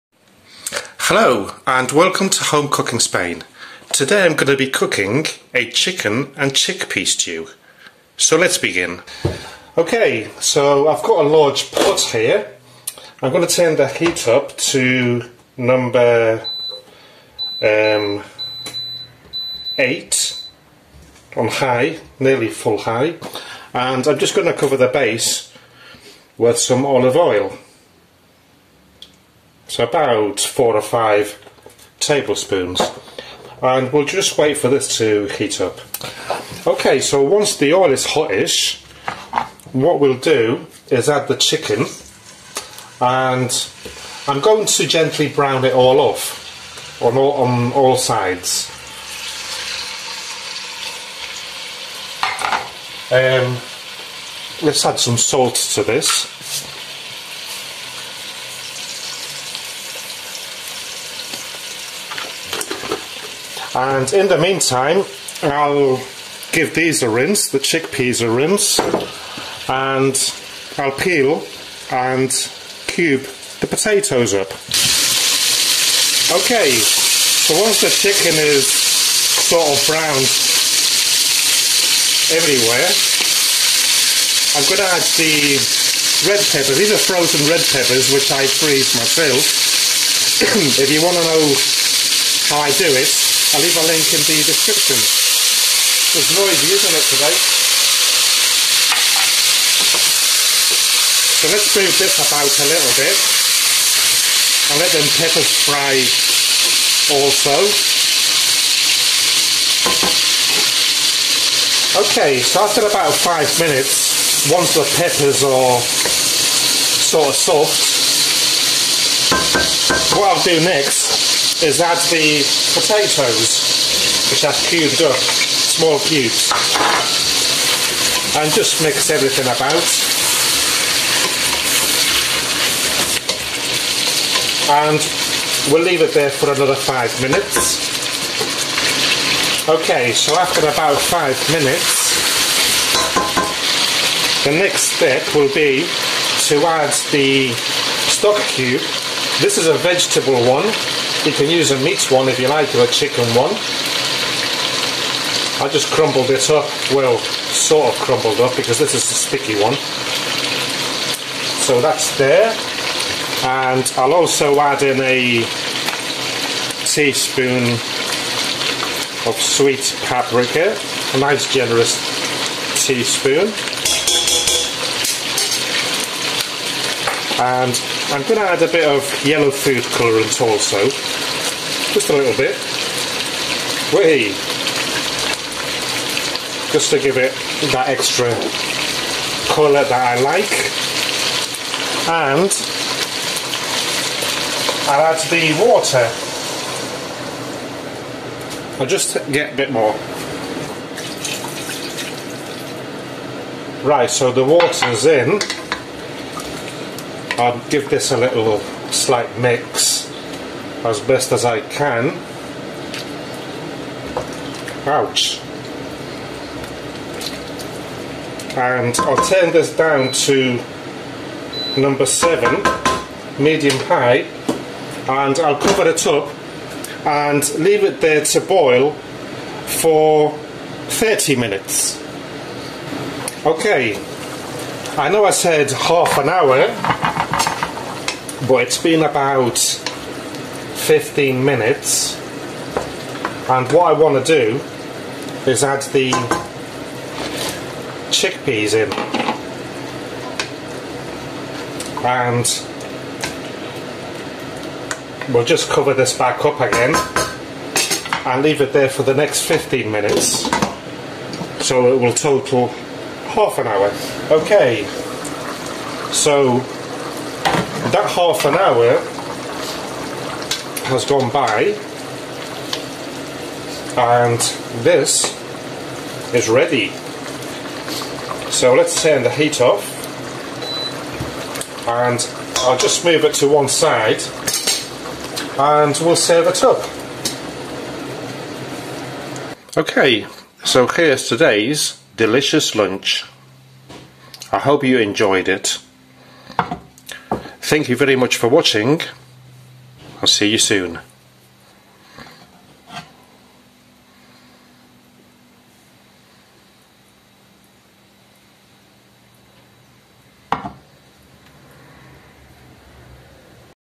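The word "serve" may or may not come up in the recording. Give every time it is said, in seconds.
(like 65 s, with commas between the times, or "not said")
286 s.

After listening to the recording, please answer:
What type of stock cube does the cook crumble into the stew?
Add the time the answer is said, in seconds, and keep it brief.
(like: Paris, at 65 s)
vegetable, at 149 s.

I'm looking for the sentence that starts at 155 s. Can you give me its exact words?
I just crumbled it up, well, sort of crumbled up, because this is a sticky one.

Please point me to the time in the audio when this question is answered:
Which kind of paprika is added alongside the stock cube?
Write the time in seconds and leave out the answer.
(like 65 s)
169 s.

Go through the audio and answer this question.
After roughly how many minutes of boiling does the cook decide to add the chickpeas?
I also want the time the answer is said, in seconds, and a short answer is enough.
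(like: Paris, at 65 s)
15 minutes, at 239 s.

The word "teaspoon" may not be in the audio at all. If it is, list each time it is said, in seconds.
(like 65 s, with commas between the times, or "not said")
166 s, 172 s.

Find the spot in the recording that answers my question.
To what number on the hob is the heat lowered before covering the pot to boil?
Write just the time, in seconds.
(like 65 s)
221 s.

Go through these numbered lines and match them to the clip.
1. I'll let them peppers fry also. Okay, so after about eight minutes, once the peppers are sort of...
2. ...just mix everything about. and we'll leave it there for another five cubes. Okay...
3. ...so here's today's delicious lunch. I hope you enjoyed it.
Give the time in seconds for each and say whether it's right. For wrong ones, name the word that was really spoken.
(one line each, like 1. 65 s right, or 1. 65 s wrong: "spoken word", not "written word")
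1. 104 s wrong: "five", not "eight"
2. 128 s wrong: "minutes", not "cubes"
3. 290 s right.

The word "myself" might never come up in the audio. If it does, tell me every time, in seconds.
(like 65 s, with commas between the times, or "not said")
88 s.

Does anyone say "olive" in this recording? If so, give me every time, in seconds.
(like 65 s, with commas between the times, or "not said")
26 s.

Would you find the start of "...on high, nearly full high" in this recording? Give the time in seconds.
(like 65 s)
21 s.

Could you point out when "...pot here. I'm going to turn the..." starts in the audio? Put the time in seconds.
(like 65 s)
11 s.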